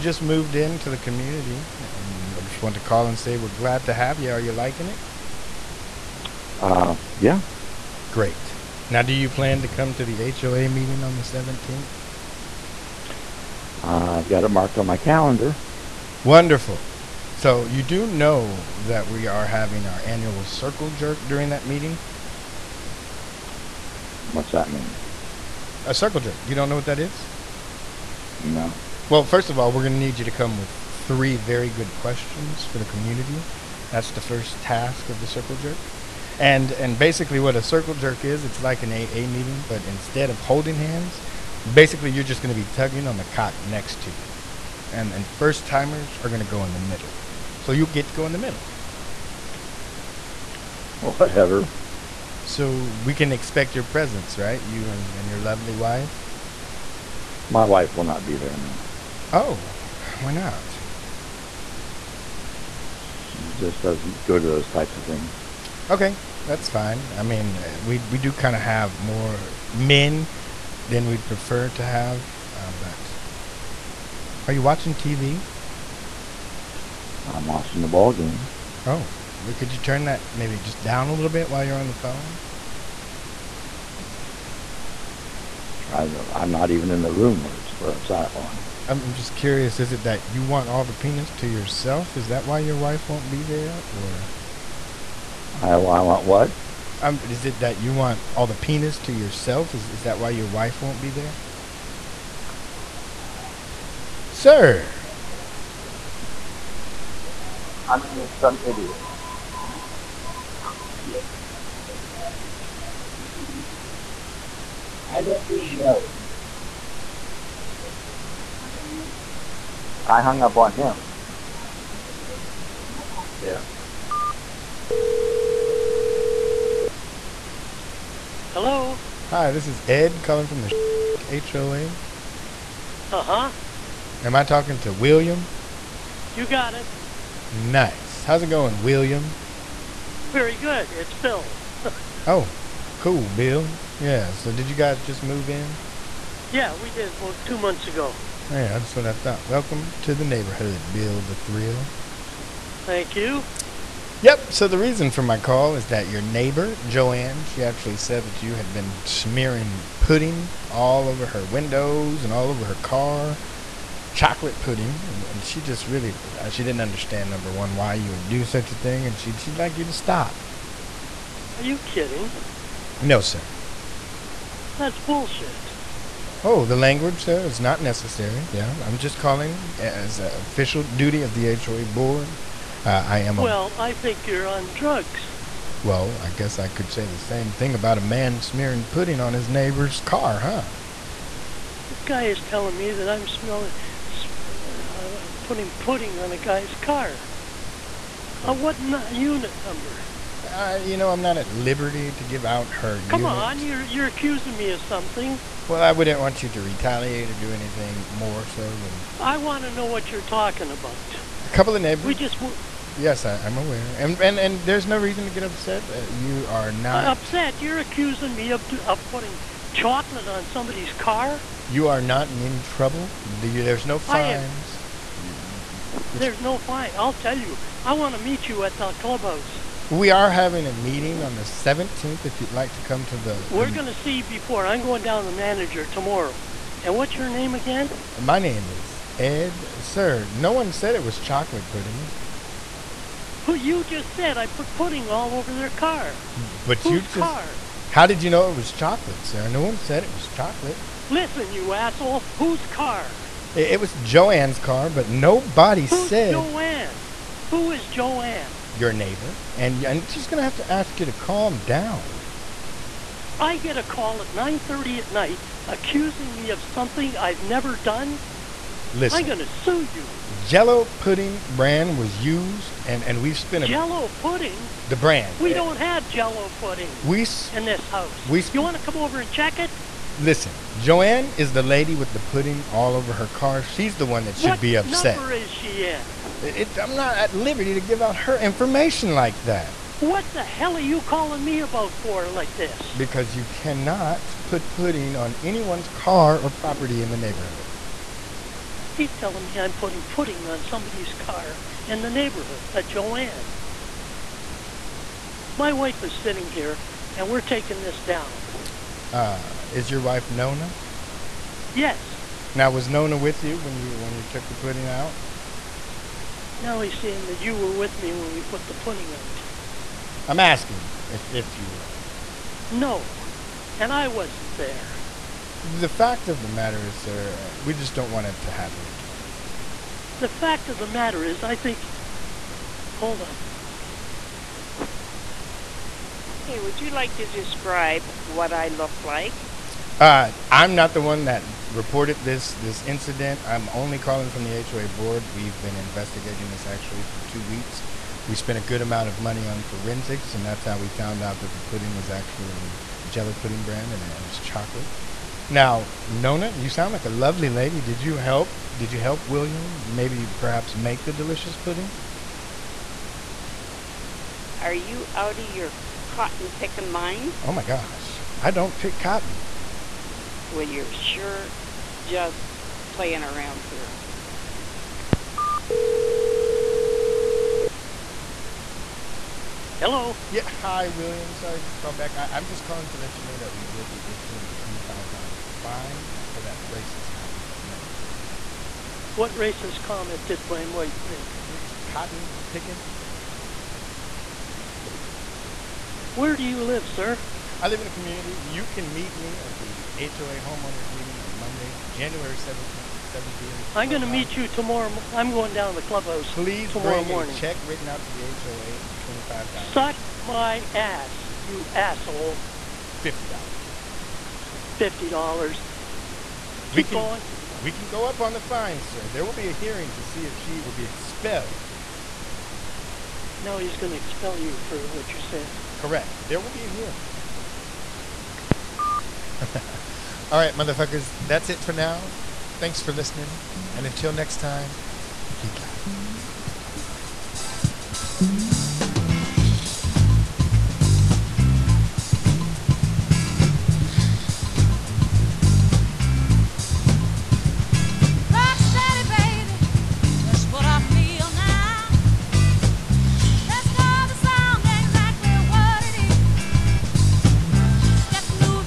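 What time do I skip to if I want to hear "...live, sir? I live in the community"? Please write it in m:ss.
6:36.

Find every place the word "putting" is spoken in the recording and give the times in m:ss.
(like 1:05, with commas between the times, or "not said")
3:15, 3:39, 4:59.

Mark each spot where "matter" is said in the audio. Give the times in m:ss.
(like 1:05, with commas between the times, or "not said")
5:26, 5:30.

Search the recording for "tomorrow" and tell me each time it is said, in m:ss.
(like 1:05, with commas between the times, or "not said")
3:55, 6:44.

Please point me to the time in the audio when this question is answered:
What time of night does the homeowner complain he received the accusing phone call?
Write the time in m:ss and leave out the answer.
4:24.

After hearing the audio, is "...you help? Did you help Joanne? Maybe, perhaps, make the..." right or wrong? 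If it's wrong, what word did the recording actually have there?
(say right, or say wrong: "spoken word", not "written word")
wrong: "William", not "Joanne".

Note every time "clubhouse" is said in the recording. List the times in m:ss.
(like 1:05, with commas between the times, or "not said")
3:48, 6:45.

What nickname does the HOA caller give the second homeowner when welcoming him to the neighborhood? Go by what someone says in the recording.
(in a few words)
Bill the Thrill.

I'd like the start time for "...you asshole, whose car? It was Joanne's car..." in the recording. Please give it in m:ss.
4:11.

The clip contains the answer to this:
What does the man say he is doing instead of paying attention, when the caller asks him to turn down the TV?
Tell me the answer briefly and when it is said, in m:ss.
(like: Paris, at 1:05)
Watching the ball game, at 1:17.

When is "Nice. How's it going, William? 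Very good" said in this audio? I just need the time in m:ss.
2:17.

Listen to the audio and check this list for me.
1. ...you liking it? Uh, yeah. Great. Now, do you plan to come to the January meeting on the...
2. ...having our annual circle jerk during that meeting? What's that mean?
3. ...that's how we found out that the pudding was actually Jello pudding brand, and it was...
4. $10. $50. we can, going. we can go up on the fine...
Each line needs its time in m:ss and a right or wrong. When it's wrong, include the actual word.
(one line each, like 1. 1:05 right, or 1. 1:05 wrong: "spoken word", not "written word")
1. 0:04 wrong: "HOA", not "January"
2. 0:19 right
3. 5:50 right
4. 6:53 wrong: "50", not "10".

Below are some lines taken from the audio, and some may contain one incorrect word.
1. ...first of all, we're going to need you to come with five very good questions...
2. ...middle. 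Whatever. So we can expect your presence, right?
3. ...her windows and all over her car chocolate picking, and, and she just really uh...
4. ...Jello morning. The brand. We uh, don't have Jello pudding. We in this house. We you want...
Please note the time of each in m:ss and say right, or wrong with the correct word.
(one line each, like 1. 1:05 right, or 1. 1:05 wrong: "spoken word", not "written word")
1. 0:29 wrong: "three", not "five"
2. 0:48 right
3. 2:41 wrong: "pudding", not "picking"
4. 4:33 wrong: "pudding", not "morning".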